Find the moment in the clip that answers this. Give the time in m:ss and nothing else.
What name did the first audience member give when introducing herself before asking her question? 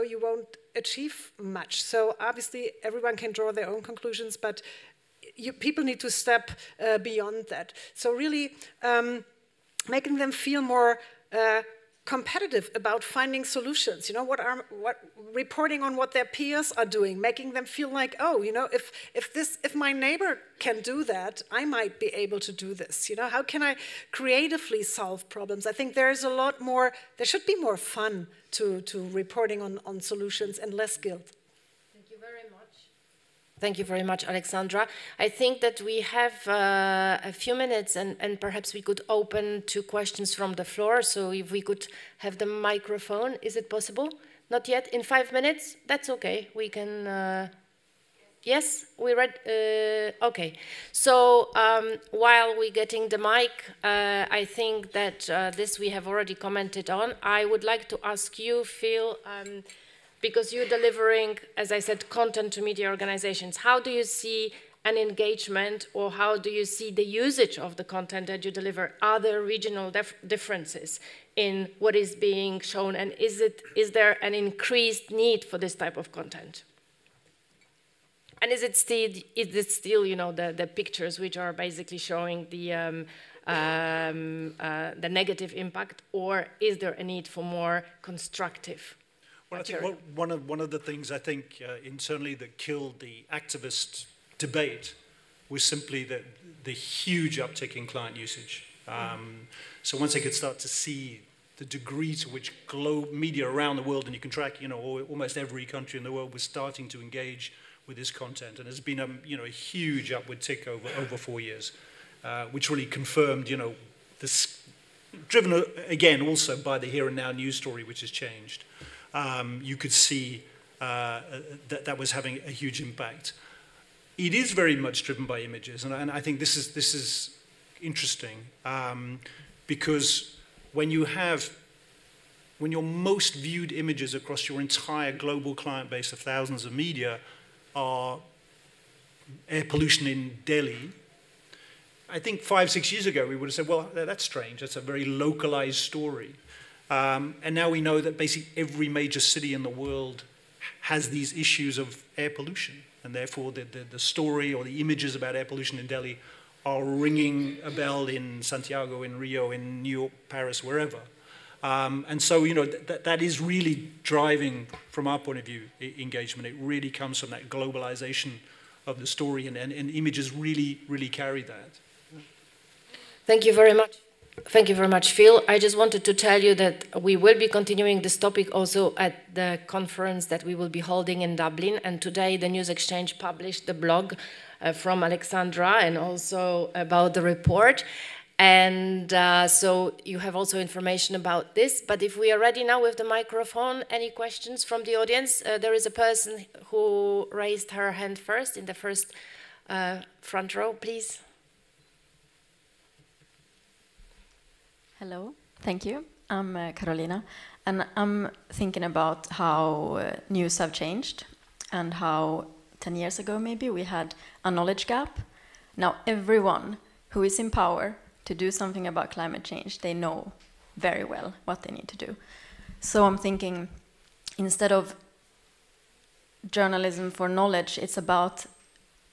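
3:26.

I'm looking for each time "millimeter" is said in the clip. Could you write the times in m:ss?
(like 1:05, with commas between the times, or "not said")
not said.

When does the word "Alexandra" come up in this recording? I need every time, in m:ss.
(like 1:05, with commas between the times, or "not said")
0:34, 3:05.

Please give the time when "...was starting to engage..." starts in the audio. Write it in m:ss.
1:46.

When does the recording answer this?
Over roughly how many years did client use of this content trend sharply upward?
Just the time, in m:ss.
1:51.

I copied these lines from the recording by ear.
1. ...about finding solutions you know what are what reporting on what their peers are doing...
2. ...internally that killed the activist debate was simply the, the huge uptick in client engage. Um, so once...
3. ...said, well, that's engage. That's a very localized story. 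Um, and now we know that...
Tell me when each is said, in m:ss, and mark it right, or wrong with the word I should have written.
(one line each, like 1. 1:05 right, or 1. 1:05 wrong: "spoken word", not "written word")
1. 0:12 right
2. 1:31 wrong: "usage", not "engage"
3. 2:23 wrong: "strange", not "engage".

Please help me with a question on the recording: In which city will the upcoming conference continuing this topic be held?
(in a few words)
Dublin.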